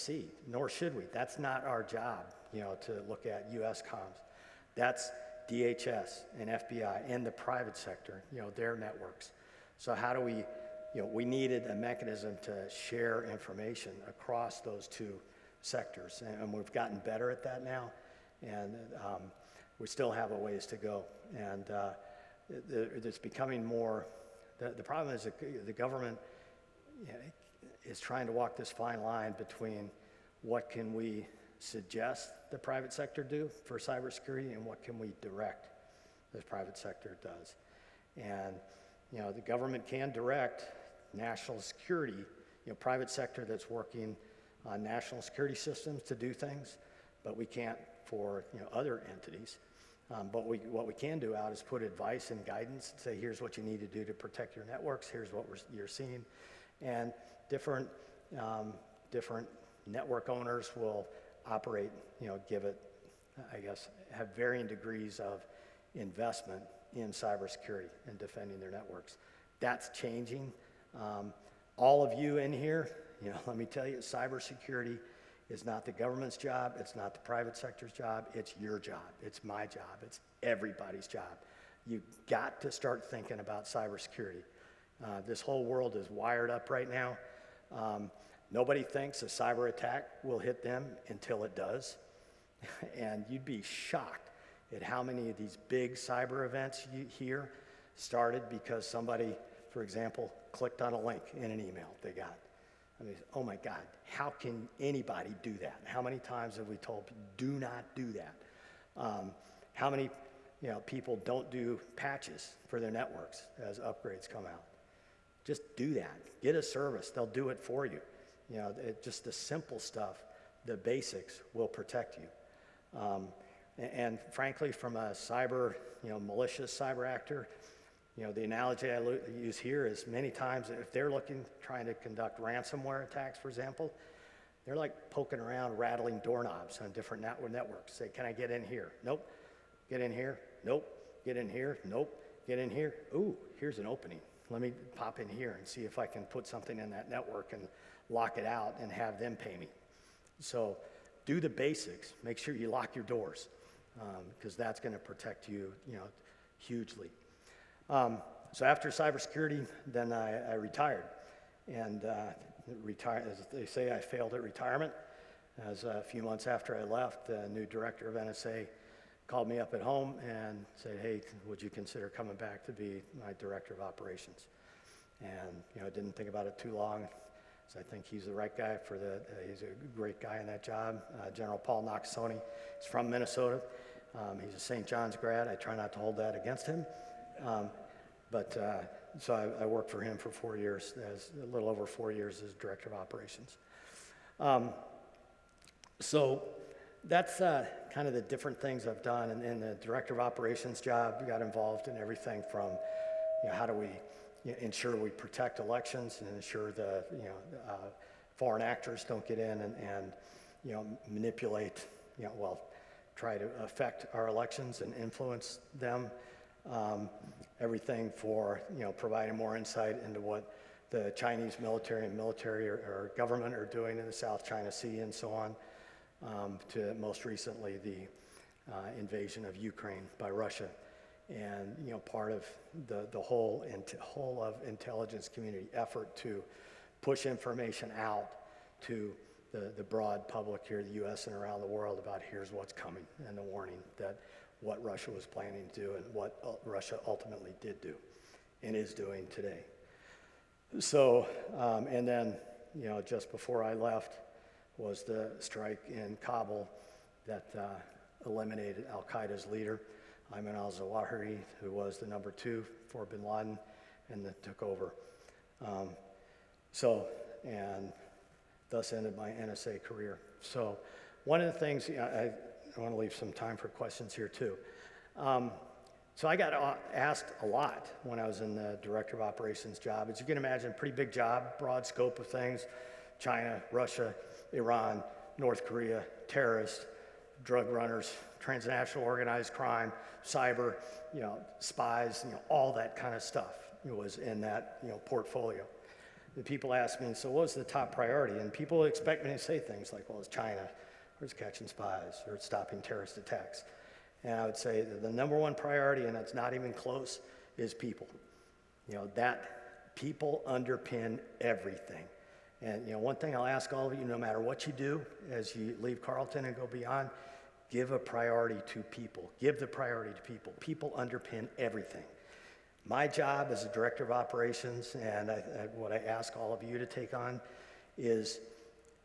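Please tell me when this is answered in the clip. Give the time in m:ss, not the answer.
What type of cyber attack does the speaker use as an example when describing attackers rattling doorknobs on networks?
2:12.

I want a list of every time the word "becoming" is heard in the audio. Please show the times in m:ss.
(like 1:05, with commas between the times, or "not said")
0:23.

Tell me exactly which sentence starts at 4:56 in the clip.
And people ask me, so what was the top priority?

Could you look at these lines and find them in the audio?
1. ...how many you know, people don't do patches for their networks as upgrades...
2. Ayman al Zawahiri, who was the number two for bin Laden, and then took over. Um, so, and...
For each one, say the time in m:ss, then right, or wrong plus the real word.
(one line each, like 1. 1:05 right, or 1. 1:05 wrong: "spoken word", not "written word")
1. 1:49 right
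2. 4:20 right.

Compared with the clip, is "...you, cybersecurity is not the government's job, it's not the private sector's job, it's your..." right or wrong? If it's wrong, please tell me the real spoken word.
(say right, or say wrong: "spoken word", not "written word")
right.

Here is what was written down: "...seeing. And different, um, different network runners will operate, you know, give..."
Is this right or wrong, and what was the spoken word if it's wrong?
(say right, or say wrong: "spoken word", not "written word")
wrong: "owners", not "runners".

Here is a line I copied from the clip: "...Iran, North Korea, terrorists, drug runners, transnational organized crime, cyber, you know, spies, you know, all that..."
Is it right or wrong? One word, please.
right.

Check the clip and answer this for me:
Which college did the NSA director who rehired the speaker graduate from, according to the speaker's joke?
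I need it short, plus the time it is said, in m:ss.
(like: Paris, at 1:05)
St. John's, at 3:04.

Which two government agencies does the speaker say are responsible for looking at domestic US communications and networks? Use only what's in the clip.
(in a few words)
DHS and FBI.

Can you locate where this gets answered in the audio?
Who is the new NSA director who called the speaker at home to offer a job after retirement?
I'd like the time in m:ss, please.
3:01.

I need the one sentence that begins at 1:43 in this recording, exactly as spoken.
I mean, oh my God, how can anybody do that?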